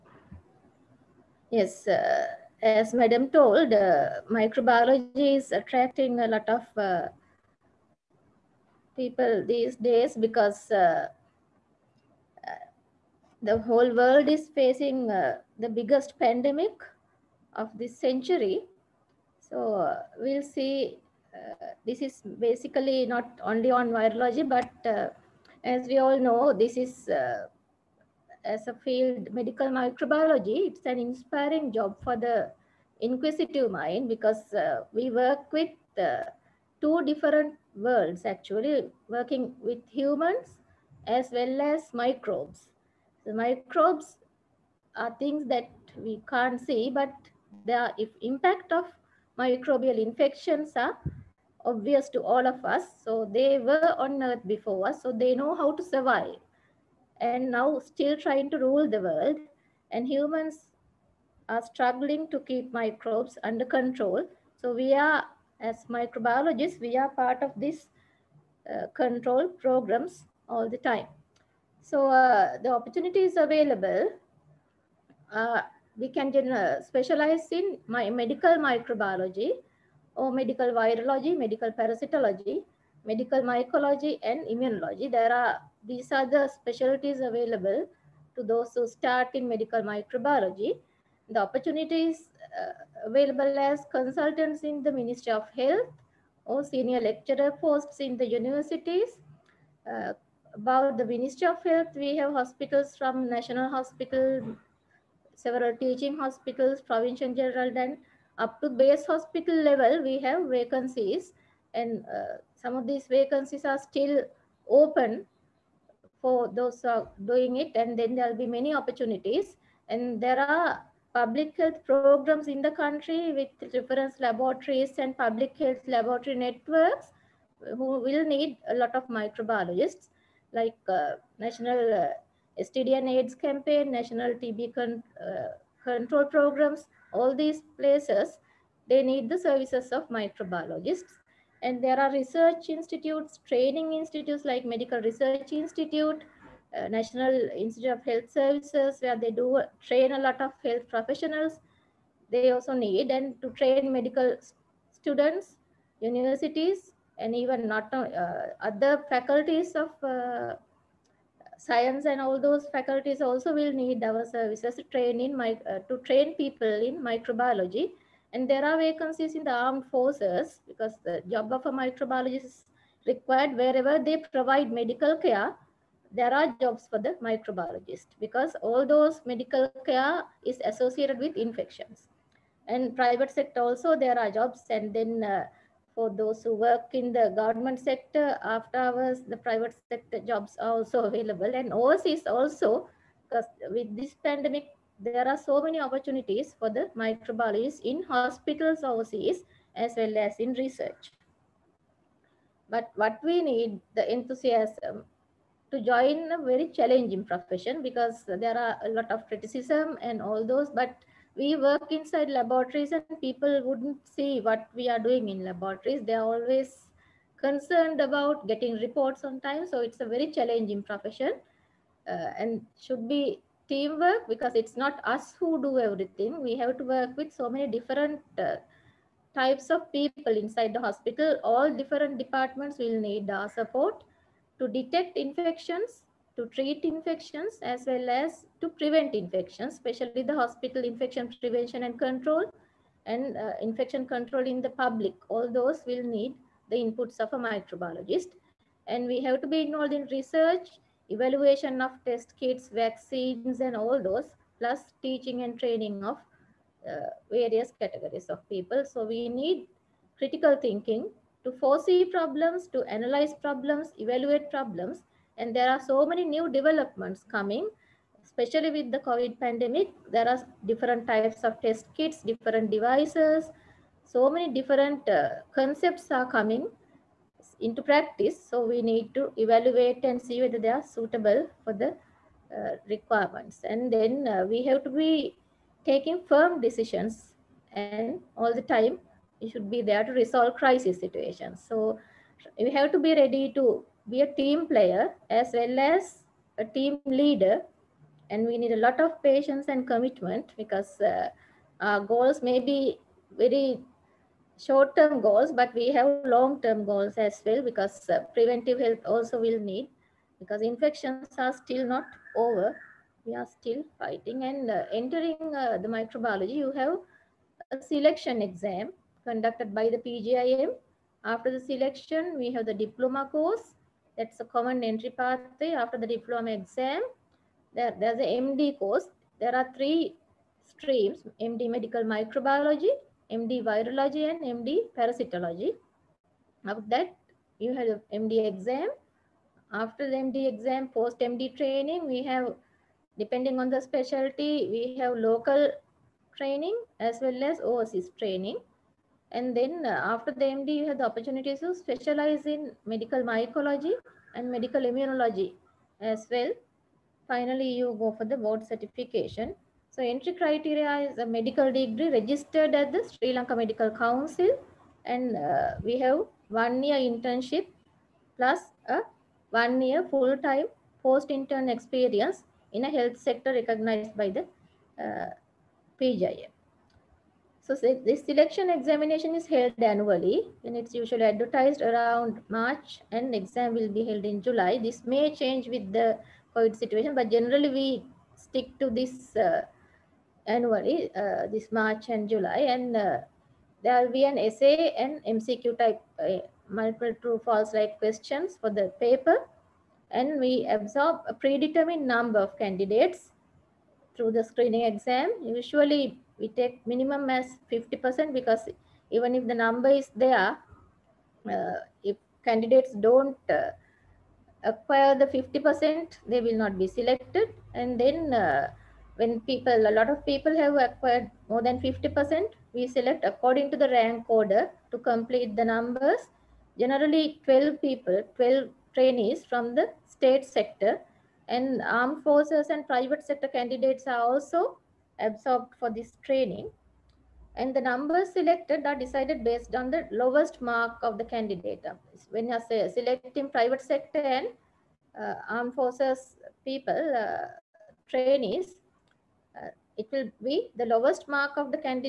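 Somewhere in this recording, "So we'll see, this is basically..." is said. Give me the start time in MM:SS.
00:19.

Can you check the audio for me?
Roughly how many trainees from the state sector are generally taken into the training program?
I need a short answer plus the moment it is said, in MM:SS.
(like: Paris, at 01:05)
12, at 07:08.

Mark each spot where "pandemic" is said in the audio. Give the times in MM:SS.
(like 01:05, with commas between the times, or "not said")
00:16, 03:14, 04:29.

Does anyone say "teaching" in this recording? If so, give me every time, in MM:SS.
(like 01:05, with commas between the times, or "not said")
01:45, 04:15.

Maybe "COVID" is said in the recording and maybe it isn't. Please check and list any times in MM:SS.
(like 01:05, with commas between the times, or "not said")
04:28, 06:26.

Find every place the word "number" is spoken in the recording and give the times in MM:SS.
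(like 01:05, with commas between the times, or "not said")
06:42, 06:49, 07:05, 07:17.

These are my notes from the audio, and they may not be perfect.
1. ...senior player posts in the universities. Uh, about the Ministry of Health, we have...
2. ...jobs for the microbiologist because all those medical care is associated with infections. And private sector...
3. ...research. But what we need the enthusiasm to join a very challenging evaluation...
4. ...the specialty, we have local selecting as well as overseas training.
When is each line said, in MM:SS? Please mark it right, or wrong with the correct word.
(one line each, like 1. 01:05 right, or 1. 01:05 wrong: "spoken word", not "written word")
1. 01:36 wrong: "lecturer", not "player"
2. 02:56 right
3. 03:20 wrong: "profession", not "evaluation"
4. 05:43 wrong: "training", not "selecting".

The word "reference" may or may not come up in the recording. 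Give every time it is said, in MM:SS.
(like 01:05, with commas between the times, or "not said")
02:03.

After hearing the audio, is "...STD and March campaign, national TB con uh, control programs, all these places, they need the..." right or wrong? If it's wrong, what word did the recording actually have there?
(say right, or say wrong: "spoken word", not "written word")
wrong: "AIDS", not "March".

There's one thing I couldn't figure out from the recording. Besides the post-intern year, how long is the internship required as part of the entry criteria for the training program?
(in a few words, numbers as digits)
1 year.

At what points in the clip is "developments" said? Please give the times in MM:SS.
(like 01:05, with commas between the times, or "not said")
04:26.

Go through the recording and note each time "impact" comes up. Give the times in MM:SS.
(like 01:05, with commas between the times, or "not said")
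00:48.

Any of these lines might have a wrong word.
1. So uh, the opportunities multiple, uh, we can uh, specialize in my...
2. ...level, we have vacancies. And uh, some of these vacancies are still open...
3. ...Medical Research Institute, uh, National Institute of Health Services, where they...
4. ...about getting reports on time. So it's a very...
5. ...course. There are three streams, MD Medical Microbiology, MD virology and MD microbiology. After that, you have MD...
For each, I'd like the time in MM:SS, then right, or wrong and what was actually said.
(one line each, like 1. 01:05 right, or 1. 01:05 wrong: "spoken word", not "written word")
1. 01:11 wrong: "available", not "multiple"
2. 01:49 right
3. 02:24 right
4. 03:38 right
5. 05:28 wrong: "parasitology", not "microbiology".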